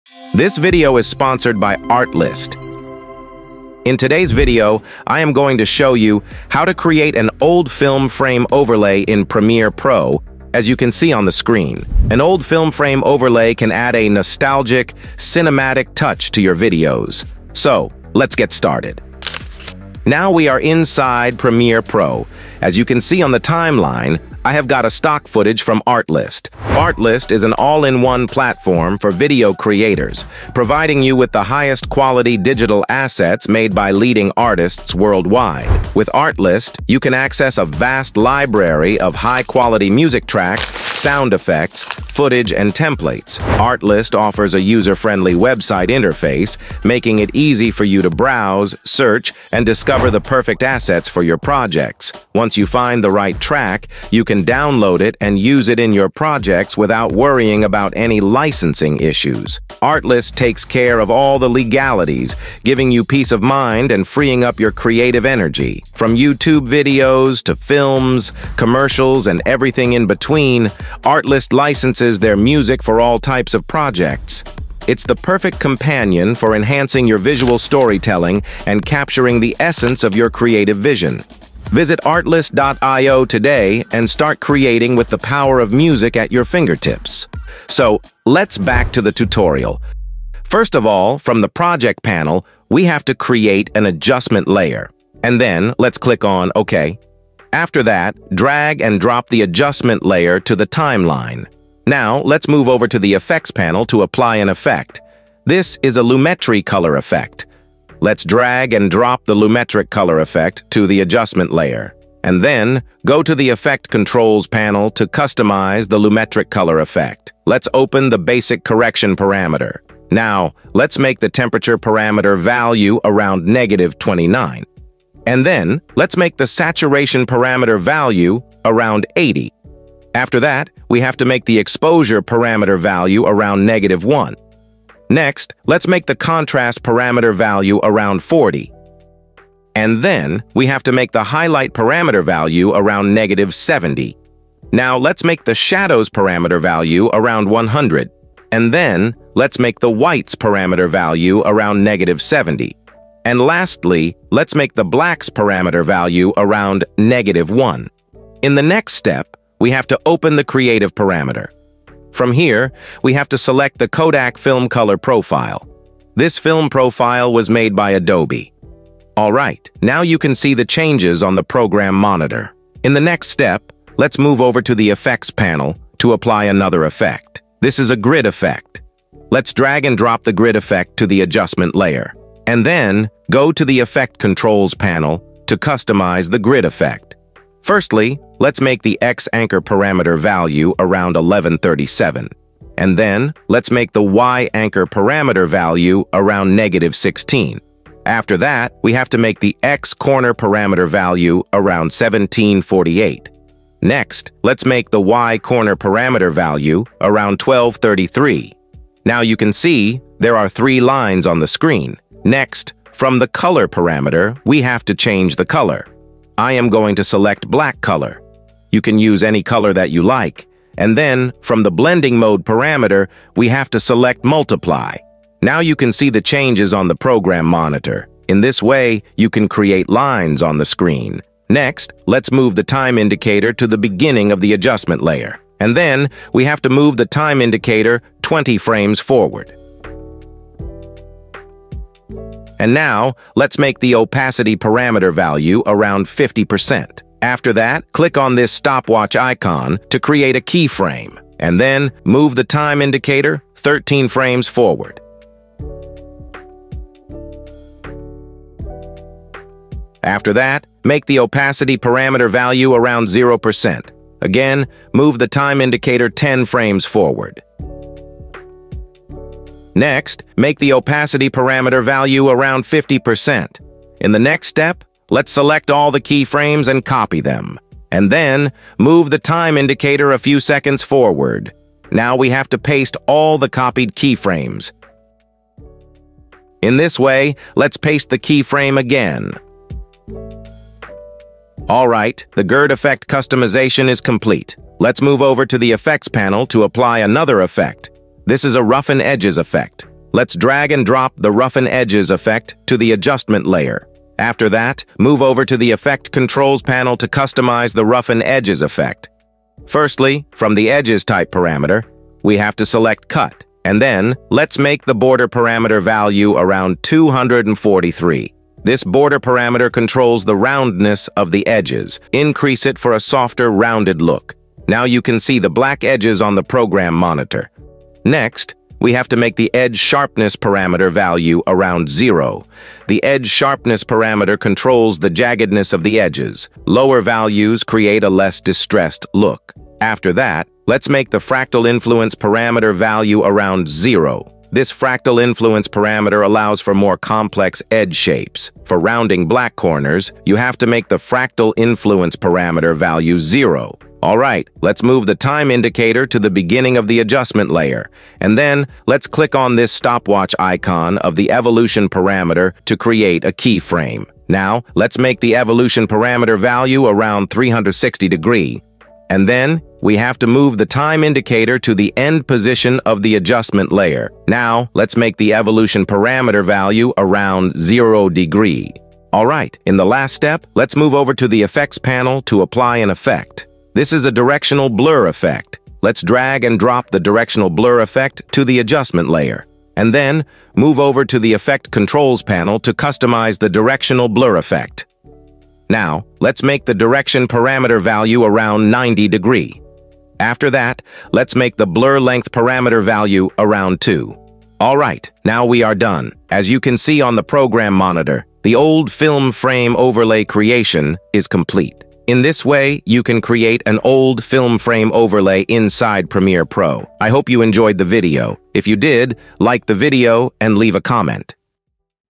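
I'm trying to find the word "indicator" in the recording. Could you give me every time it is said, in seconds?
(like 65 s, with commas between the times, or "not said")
232 s, 237 s, 252 s, 265 s, 279 s, 355 s, 371 s.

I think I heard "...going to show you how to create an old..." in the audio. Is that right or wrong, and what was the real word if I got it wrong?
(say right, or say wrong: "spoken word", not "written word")
right.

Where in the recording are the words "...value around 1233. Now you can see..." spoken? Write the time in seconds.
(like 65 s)
206 s.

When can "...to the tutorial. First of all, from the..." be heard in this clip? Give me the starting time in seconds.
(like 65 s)
88 s.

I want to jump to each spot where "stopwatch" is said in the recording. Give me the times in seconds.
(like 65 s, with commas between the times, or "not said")
248 s, 359 s.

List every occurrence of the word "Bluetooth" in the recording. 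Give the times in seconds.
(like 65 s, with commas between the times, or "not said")
not said.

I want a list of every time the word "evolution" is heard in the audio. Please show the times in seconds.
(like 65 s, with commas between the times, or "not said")
361 s, 365 s, 375 s.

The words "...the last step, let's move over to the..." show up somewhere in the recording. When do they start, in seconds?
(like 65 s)
379 s.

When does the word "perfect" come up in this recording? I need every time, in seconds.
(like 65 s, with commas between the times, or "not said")
50 s, 75 s.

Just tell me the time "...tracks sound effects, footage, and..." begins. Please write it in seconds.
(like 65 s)
40 s.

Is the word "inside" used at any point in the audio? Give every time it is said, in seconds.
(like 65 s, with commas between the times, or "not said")
20 s, 415 s.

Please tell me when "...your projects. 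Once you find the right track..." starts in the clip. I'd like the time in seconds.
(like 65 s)
51 s.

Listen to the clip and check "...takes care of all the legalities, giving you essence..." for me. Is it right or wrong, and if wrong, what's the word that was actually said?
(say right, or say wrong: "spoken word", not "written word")
wrong: "peace", not "essence".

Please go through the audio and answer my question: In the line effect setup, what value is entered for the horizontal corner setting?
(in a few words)
1748.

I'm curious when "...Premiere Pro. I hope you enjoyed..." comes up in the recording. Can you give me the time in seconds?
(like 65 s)
416 s.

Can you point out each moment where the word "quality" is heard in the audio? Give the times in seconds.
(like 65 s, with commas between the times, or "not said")
31 s, 39 s.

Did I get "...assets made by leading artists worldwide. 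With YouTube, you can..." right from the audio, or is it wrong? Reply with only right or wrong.
wrong.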